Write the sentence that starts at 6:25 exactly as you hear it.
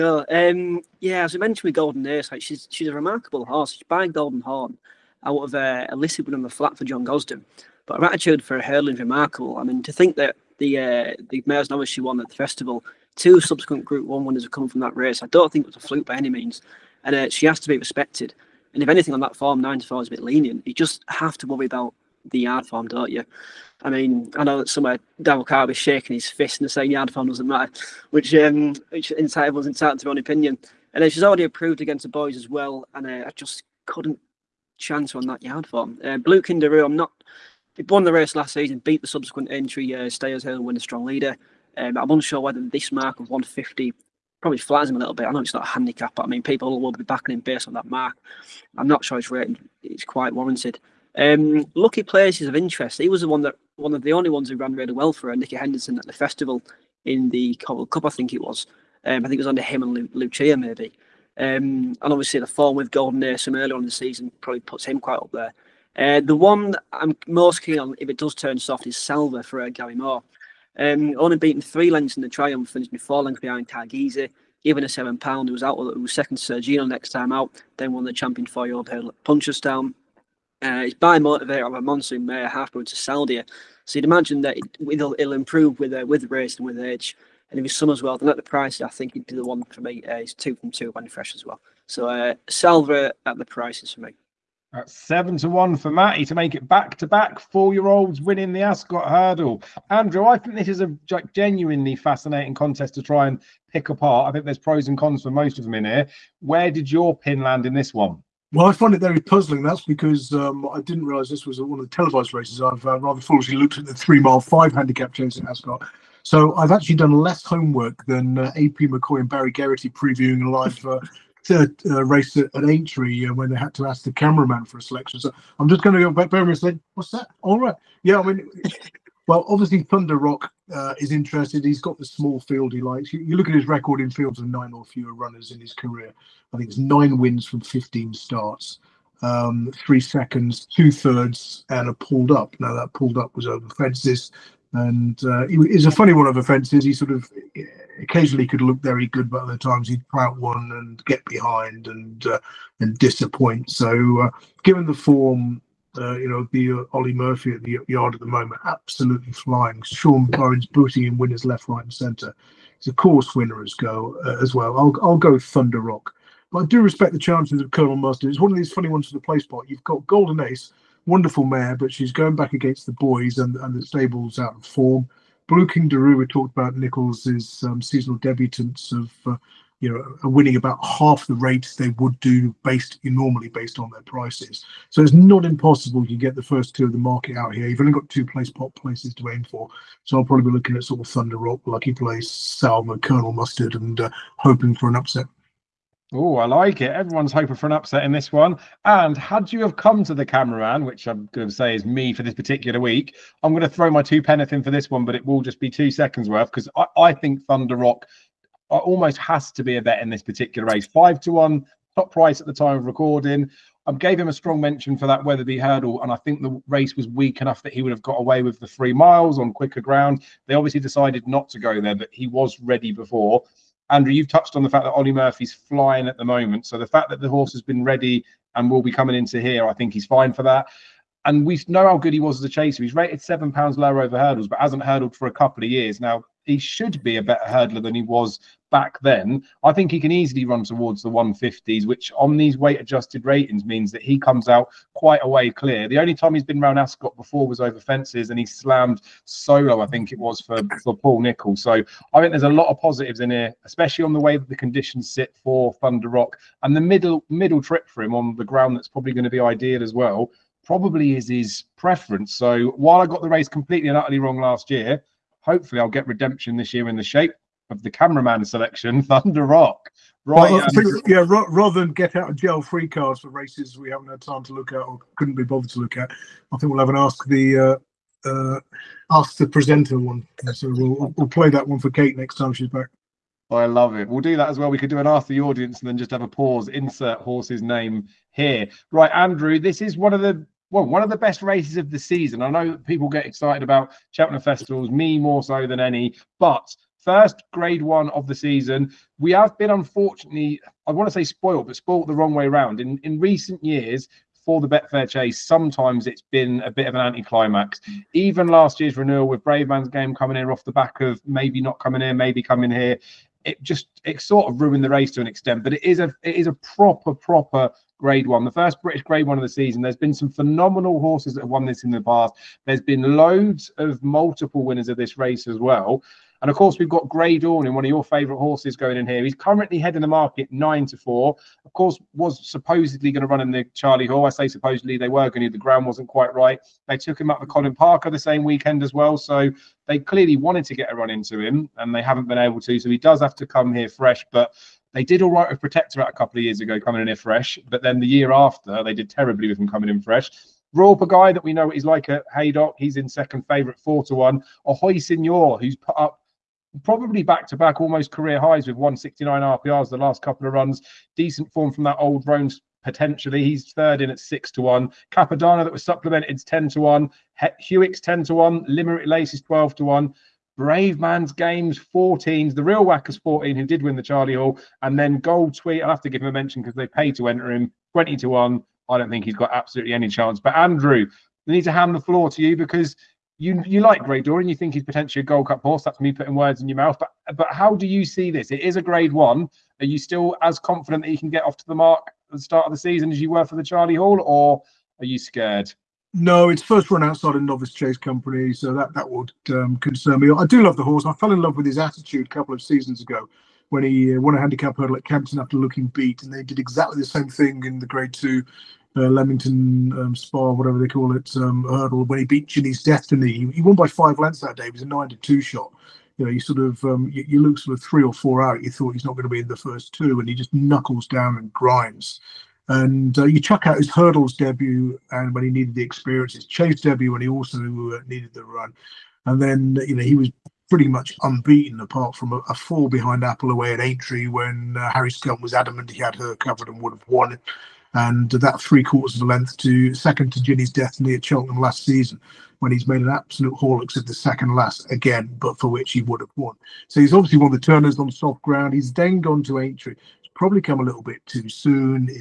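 That's me putting words in your mouth.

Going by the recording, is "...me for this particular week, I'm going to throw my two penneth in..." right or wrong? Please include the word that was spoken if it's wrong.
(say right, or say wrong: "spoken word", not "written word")
right.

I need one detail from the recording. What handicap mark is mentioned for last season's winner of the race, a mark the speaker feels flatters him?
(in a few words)
150.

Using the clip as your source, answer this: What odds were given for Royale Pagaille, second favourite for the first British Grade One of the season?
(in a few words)
4/1.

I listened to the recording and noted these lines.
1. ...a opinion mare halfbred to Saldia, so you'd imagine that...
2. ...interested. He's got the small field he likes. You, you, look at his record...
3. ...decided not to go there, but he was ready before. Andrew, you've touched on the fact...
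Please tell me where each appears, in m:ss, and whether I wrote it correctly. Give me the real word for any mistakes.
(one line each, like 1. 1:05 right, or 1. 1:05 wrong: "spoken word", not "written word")
1. 1:21 wrong: "monsoon", not "opinion"
2. 2:11 right
3. 3:40 right.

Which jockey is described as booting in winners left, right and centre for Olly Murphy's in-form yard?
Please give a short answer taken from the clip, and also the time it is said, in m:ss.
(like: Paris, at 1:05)
Sean Burns, at 2:39.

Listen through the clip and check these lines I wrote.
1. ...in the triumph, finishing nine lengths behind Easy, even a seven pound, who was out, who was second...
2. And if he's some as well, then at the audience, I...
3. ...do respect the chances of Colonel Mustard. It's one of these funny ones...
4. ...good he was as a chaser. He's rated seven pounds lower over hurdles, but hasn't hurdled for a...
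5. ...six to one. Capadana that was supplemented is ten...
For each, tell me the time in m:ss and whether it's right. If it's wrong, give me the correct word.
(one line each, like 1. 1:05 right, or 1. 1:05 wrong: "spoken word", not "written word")
1. 1:12 wrong: "four", not "nine"
2. 1:27 wrong: "price", not "audience"
3. 2:46 right
4. 3:51 right
5. 6:04 right.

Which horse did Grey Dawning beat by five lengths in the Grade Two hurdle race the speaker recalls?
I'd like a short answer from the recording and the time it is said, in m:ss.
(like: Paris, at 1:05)
Ginny's Destiny, at 6:52.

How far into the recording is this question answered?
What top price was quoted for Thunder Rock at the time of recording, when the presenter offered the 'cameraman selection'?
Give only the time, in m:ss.
3:30.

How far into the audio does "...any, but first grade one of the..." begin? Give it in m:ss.
4:55.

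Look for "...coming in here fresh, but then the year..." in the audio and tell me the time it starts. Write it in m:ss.
5:46.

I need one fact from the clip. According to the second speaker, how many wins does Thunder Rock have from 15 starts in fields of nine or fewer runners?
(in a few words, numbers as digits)
9.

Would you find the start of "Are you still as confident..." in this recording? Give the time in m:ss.
6:29.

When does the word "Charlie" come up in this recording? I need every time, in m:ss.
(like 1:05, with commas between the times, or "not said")
5:33, 6:14, 6:33.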